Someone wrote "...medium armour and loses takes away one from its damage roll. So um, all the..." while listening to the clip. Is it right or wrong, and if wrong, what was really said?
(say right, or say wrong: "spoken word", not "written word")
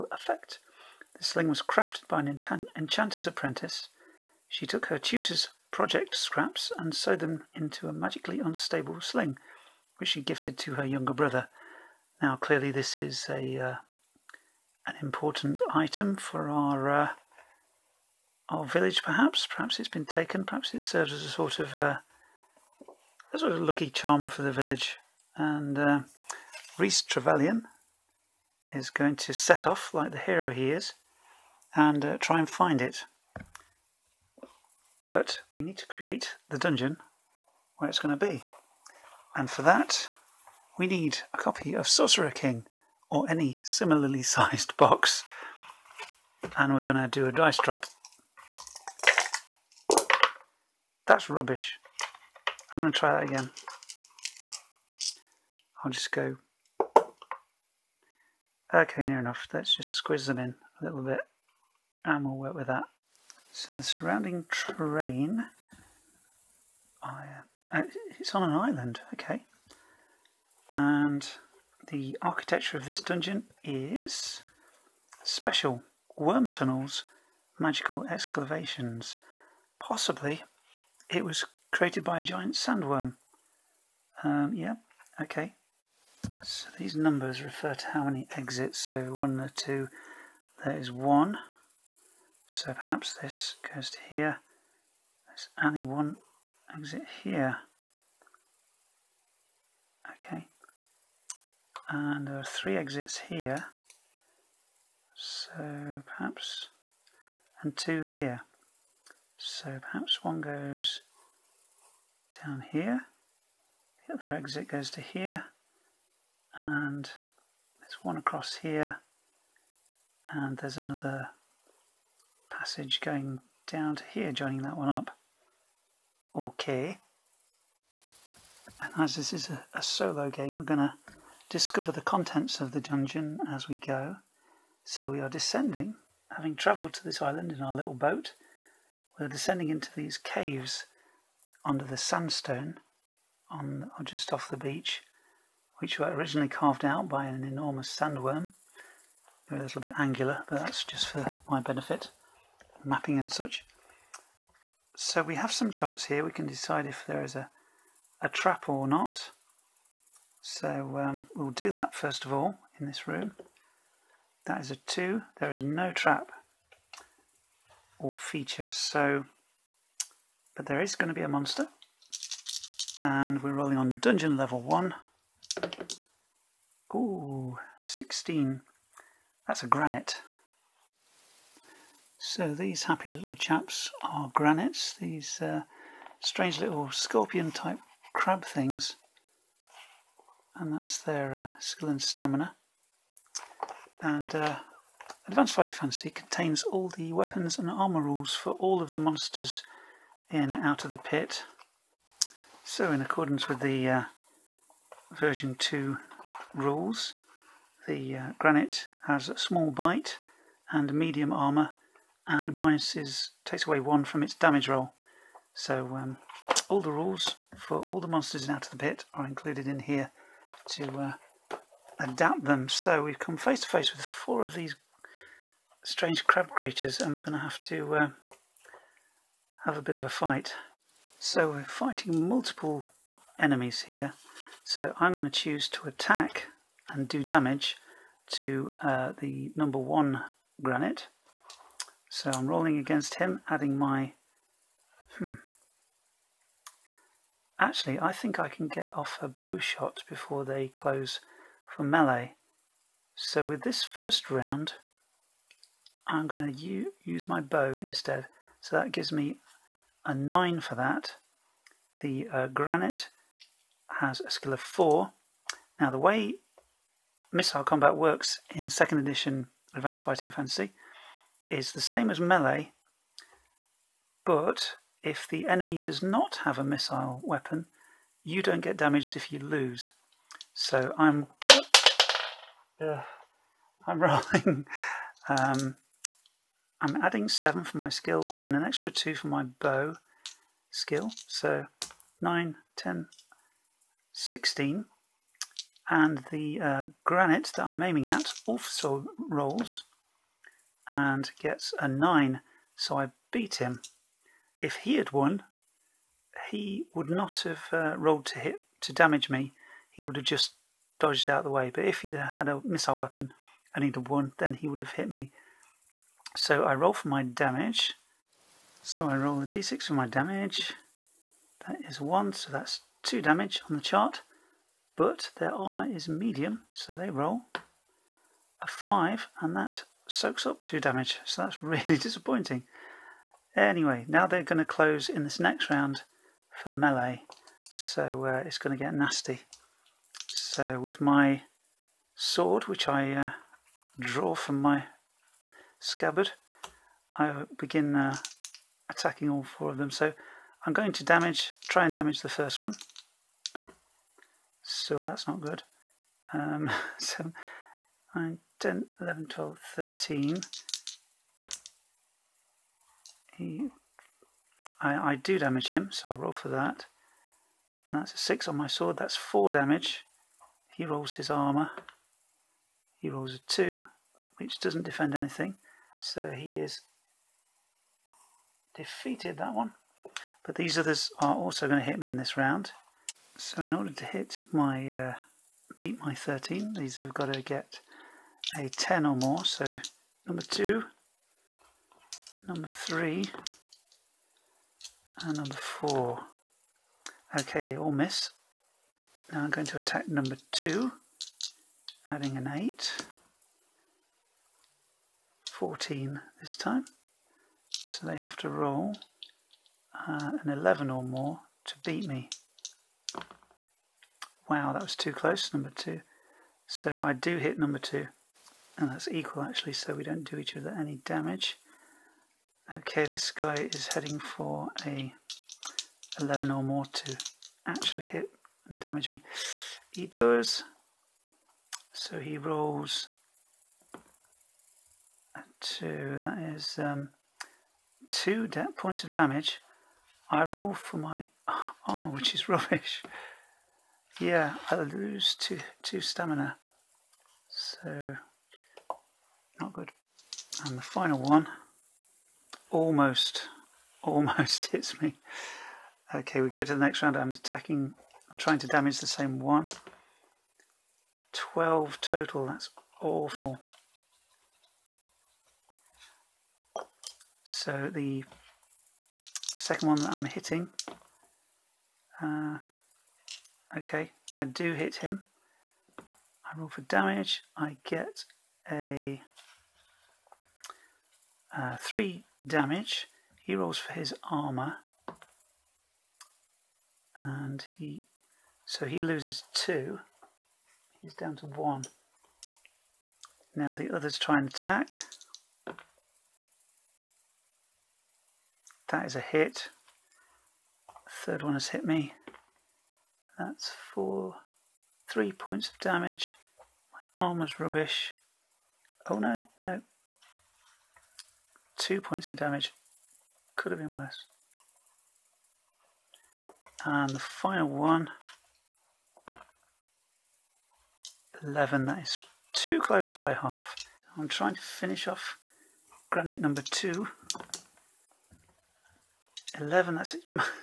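wrong: "minuses", not "loses".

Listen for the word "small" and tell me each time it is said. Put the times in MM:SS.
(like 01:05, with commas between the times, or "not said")
03:29.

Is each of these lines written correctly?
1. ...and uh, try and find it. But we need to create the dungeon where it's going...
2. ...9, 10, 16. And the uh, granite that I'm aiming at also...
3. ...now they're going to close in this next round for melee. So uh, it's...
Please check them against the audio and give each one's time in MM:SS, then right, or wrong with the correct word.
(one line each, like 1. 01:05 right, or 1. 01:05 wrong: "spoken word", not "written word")
1. 00:31 right
2. 04:52 right
3. 05:34 right.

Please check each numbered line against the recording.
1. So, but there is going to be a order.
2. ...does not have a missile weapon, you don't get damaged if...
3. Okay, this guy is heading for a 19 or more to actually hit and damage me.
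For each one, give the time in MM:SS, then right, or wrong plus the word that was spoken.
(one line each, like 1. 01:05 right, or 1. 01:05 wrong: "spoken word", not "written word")
1. 02:48 wrong: "monster", not "order"
2. 04:35 right
3. 07:02 wrong: "11", not "19".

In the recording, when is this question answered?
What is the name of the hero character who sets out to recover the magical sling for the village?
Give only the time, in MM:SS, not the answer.
00:26.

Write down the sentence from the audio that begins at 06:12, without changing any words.
He rolls a 2, which doesn't defend anything.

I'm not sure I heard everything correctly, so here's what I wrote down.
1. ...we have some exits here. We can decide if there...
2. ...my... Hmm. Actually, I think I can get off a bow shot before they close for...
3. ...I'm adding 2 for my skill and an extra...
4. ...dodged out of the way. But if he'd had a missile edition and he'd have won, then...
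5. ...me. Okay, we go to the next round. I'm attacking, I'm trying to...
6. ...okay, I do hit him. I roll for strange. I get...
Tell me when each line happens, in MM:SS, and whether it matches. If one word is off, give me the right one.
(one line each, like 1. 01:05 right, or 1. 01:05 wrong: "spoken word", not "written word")
1. 02:35 wrong: "charts", not "exits"
2. 04:03 right
3. 04:46 wrong: "7", not "2"
4. 05:10 wrong: "weapon", not "edition"
5. 07:35 right
6. 07:53 wrong: "damage", not "strange".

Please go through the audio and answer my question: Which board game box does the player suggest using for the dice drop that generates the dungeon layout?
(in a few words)
Sorcerer King.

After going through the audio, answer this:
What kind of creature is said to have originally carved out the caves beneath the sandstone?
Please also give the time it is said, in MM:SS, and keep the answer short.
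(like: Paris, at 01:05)
giant sandworm, at 01:22.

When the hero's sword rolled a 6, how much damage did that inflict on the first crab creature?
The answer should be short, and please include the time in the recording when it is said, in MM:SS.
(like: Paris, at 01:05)
4, at 06:09.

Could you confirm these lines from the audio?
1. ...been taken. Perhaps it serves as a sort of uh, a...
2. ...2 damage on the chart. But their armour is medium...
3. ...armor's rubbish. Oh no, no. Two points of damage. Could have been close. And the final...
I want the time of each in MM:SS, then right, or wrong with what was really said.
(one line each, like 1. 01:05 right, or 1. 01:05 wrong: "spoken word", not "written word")
1. 00:19 right
2. 05:23 right
3. 08:27 wrong: "worse", not "close".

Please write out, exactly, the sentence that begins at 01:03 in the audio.
So the surrounding terrain, I, uh, uh, it's on an island, okay.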